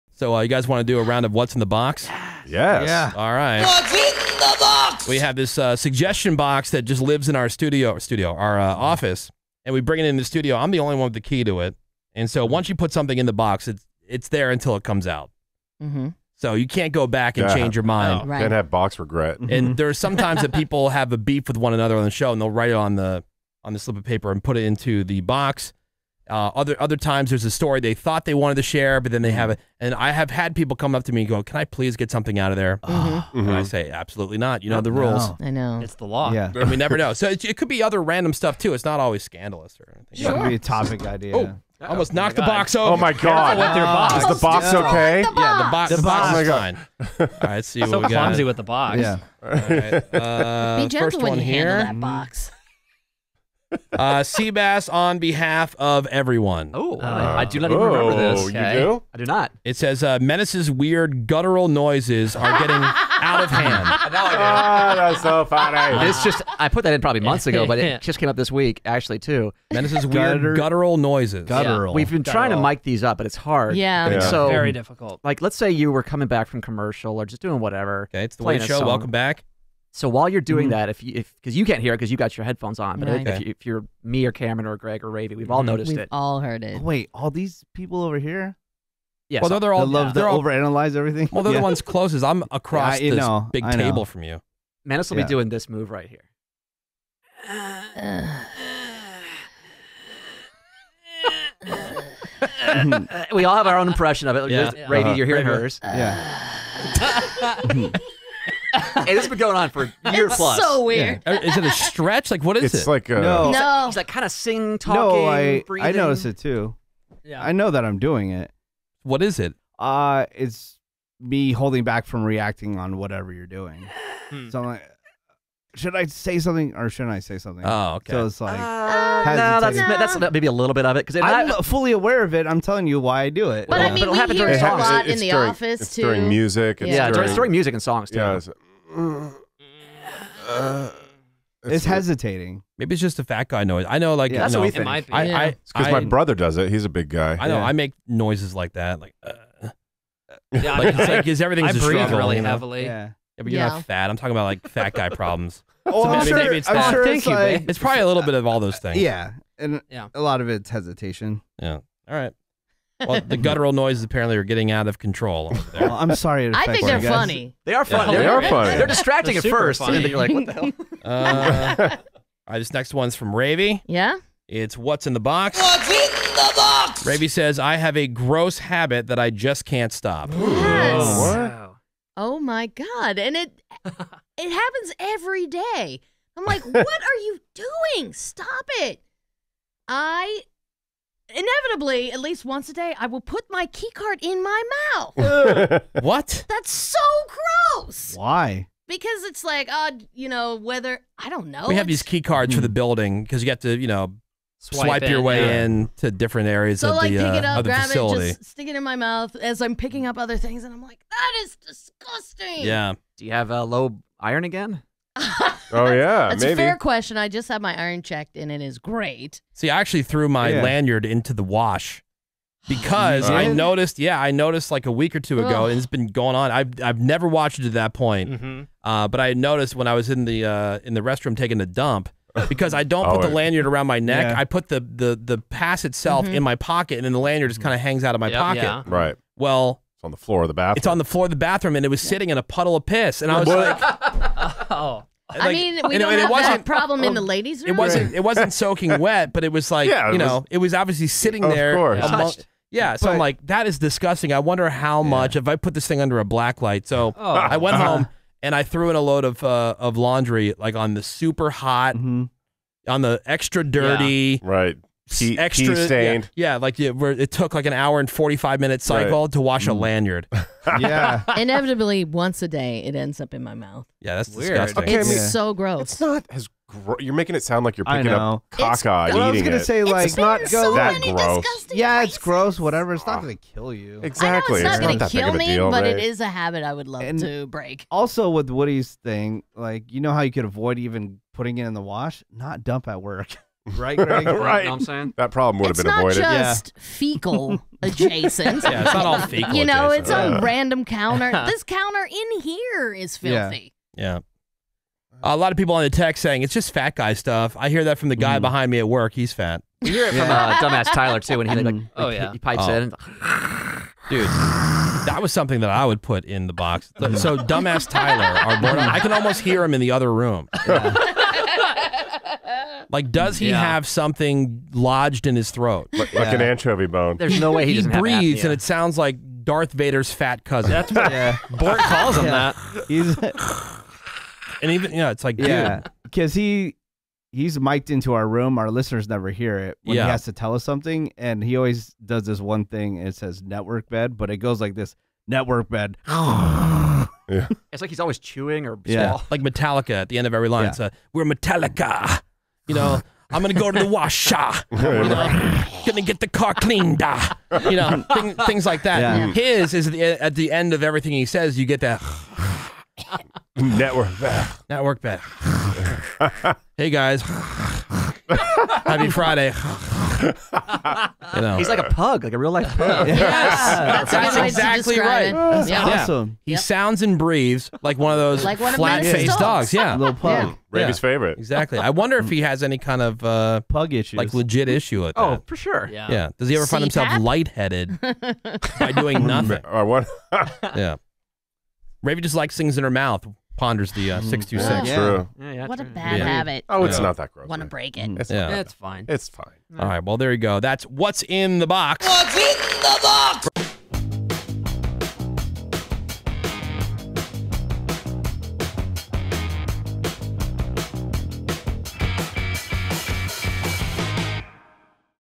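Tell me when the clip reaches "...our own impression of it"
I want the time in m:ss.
1:43.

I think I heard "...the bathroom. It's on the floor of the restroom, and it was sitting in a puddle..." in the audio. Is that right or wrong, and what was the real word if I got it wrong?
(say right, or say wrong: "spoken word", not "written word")
wrong: "bathroom", not "restroom".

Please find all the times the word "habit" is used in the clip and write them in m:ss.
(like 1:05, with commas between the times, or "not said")
2:58, 4:46, 6:36.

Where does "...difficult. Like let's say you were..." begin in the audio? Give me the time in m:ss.
1:14.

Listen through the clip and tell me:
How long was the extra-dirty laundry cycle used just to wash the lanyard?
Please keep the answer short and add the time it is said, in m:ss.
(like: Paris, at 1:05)
1 hour and 45 minutes, at 4:27.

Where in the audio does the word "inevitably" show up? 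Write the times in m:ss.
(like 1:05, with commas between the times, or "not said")
3:11, 4:31.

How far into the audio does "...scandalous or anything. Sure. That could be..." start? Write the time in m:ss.
0:39.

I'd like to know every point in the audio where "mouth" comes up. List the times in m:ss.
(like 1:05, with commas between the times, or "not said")
3:14, 3:28, 4:33, 6:32.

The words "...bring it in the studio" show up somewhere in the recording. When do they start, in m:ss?
0:09.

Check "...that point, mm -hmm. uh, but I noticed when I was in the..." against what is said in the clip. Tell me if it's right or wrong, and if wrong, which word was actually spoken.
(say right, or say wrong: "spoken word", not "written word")
right.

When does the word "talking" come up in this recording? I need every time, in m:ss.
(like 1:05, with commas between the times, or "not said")
1:54, 2:34.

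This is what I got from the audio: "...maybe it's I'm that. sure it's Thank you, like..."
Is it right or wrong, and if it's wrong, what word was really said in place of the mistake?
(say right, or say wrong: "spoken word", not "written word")
right.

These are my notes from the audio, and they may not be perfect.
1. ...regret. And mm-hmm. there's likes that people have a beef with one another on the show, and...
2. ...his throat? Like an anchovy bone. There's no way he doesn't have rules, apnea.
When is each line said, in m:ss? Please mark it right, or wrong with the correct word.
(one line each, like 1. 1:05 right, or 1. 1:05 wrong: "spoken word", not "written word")
1. 0:18 wrong: "sometimes", not "likes"
2. 5:25 wrong: "breathes", not "rules".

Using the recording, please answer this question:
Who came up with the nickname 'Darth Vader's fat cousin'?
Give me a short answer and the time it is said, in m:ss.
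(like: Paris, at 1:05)
Bort, at 5:31.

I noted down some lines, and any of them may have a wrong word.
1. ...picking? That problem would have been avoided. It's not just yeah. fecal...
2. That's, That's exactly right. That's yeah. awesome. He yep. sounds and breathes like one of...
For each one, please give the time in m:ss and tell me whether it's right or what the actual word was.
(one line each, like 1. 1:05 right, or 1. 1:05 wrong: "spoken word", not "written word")
1. 4:54 wrong: "saying", not "picking"
2. 6:13 right.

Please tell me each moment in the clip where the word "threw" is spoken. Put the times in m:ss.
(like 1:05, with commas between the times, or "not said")
3:40, 4:18.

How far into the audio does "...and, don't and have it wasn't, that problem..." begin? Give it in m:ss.
4:05.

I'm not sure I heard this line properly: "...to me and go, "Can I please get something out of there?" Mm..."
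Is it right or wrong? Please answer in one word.
right.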